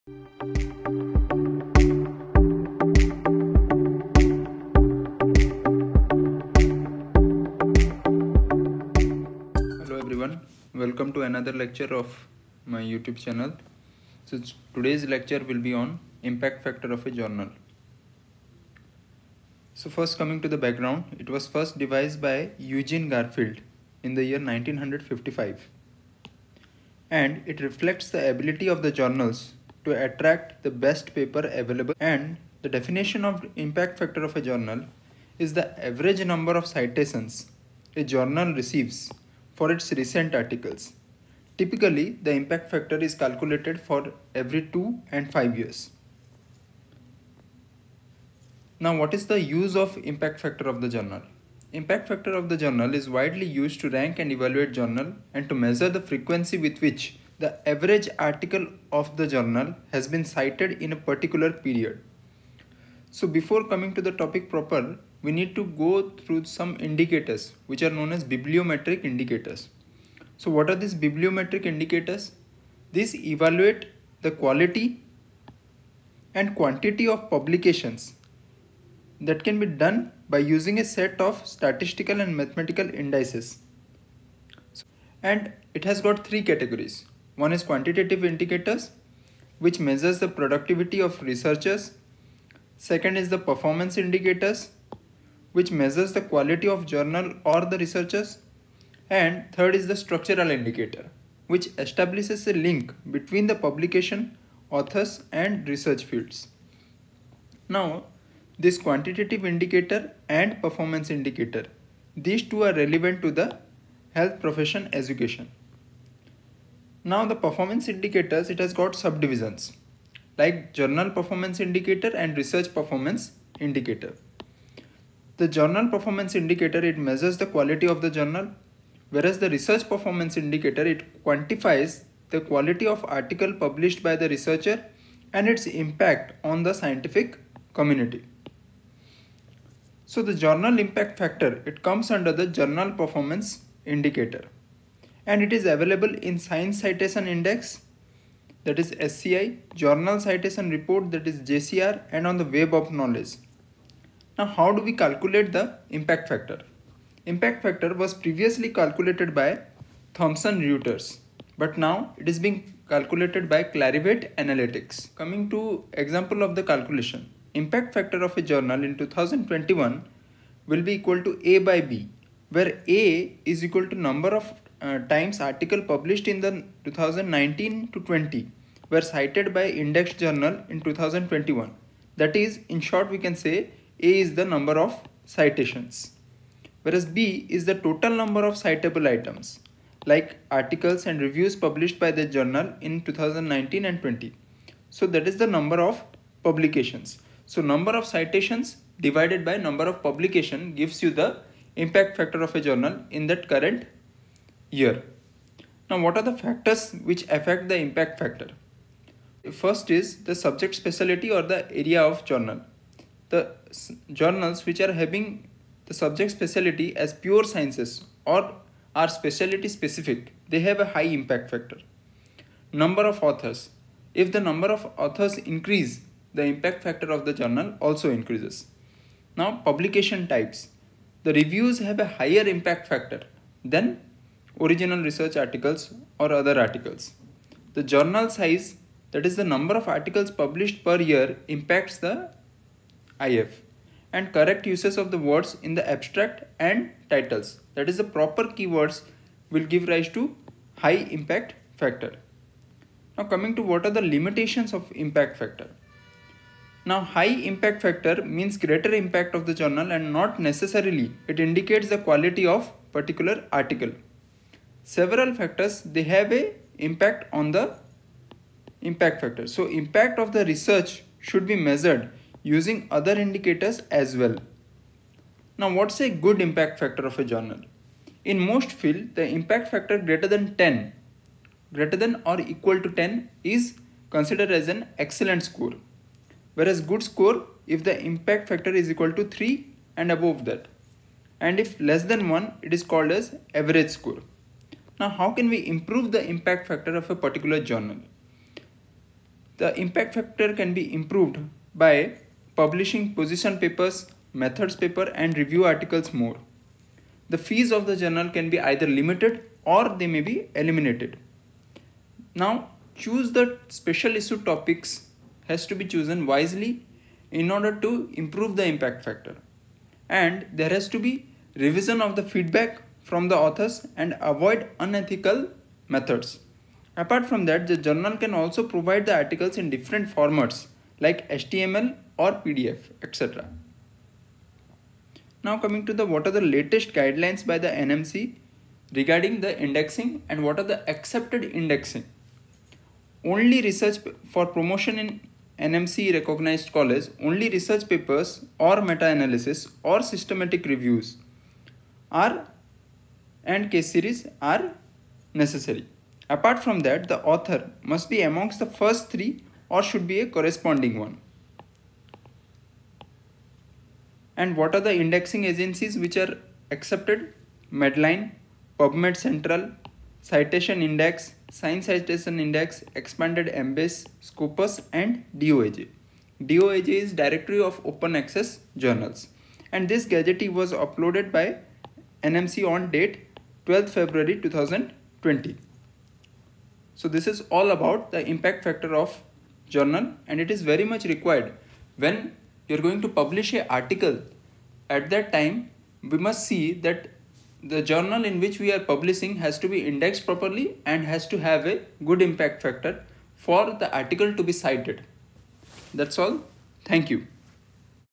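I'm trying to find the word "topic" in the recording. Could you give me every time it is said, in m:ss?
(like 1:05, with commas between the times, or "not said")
1:04, 5:14.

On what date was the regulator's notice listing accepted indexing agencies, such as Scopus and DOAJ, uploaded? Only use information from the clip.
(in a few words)
12 February 2020.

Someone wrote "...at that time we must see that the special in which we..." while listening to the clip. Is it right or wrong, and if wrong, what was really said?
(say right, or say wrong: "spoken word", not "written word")
wrong: "journal", not "special".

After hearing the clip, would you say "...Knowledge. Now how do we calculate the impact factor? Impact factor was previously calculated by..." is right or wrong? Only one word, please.
right.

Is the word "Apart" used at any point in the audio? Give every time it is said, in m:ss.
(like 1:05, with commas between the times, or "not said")
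5:26, 5:56.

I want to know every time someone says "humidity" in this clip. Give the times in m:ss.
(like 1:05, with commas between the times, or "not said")
not said.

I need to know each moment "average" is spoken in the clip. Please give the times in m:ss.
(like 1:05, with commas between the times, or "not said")
0:35, 0:57, 4:53.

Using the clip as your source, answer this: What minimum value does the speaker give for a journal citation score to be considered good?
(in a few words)
3.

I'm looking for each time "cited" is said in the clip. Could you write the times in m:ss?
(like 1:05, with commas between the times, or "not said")
1:00, 2:59, 6:44.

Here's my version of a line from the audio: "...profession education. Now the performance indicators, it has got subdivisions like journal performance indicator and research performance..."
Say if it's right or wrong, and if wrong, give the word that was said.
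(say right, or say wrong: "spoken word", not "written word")
right.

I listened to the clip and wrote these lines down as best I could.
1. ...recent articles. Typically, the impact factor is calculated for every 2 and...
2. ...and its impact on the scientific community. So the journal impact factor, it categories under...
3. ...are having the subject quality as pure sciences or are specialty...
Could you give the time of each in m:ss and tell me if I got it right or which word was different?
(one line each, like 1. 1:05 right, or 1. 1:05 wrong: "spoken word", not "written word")
1. 0:39 right
2. 2:15 wrong: "comes", not "categories"
3. 3:34 wrong: "specialty", not "quality".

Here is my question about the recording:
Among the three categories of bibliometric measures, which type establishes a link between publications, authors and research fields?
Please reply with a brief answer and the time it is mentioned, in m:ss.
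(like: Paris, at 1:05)
structural indicator, at 1:39.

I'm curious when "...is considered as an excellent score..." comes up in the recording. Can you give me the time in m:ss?
4:43.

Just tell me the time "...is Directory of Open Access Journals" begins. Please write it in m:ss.
6:16.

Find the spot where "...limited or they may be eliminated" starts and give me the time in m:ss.
5:08.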